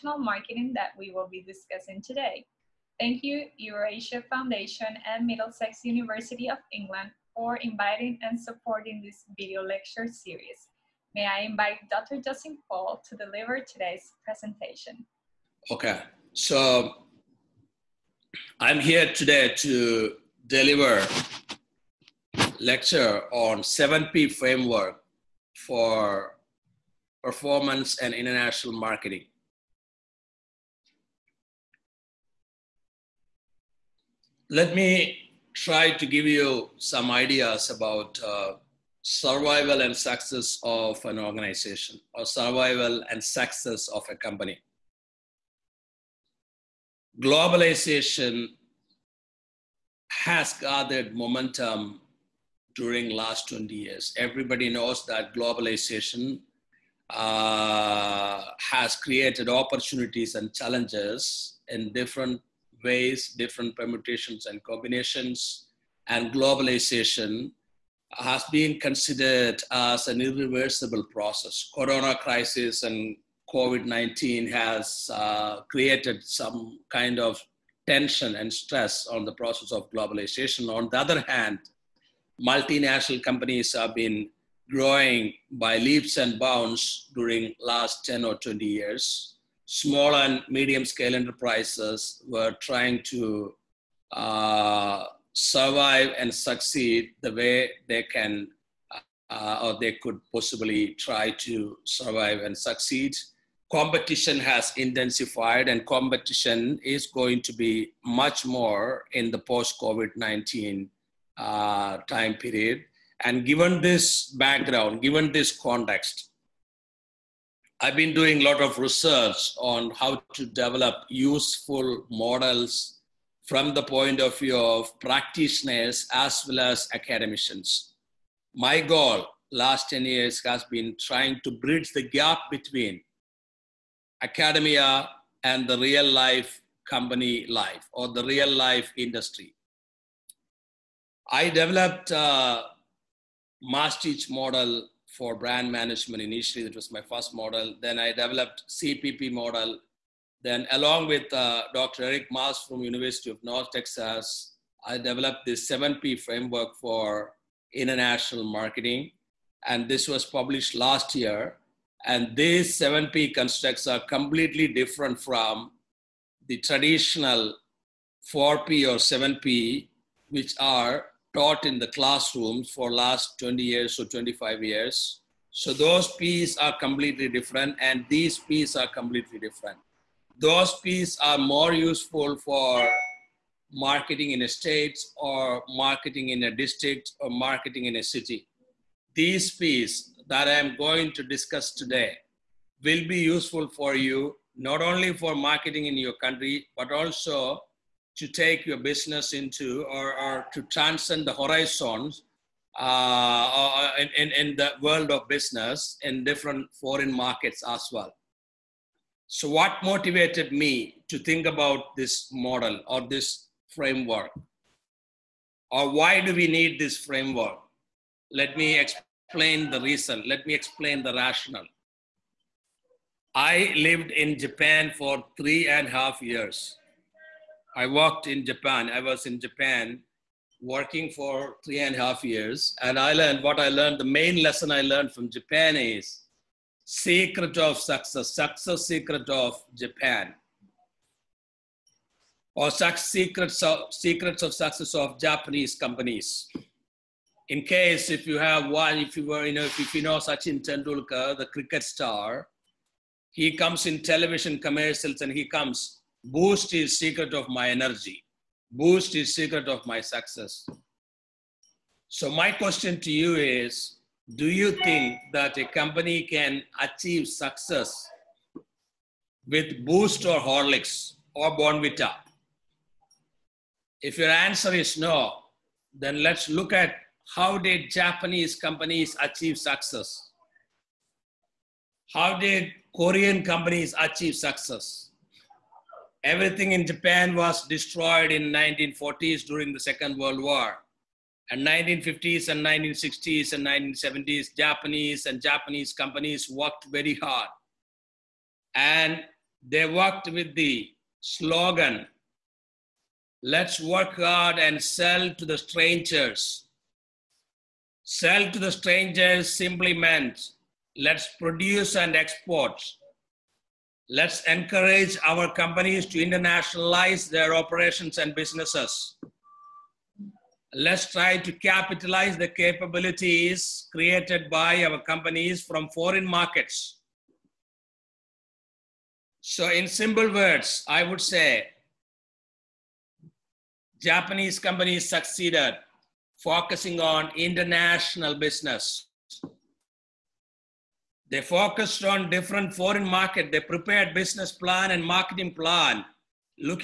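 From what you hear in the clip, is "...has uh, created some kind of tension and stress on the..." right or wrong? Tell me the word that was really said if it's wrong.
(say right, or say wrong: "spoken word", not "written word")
right.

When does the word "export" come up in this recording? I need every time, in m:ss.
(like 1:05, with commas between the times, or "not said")
5:12.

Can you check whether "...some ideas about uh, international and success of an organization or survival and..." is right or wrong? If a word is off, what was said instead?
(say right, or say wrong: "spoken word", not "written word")
wrong: "survival", not "international".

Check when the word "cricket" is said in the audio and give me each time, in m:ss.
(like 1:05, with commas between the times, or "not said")
4:11.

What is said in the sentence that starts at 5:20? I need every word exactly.
Let's try to capitalize the capabilities created by our companies from foreign markets.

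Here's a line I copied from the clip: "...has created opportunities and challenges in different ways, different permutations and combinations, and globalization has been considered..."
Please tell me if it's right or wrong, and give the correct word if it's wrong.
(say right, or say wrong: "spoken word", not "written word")
right.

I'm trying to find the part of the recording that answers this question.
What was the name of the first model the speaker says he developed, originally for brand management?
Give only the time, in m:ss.
2:23.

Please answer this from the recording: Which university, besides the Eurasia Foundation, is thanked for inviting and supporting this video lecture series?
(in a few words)
Middlesex University.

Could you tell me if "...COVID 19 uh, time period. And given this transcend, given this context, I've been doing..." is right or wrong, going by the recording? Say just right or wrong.
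wrong.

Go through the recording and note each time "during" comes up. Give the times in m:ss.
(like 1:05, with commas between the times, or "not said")
0:52, 1:27, 4:49.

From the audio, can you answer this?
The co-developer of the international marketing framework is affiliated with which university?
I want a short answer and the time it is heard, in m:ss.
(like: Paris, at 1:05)
University of North Texas, at 2:32.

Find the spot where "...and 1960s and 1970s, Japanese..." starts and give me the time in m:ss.
4:52.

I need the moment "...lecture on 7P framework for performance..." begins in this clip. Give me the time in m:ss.
0:22.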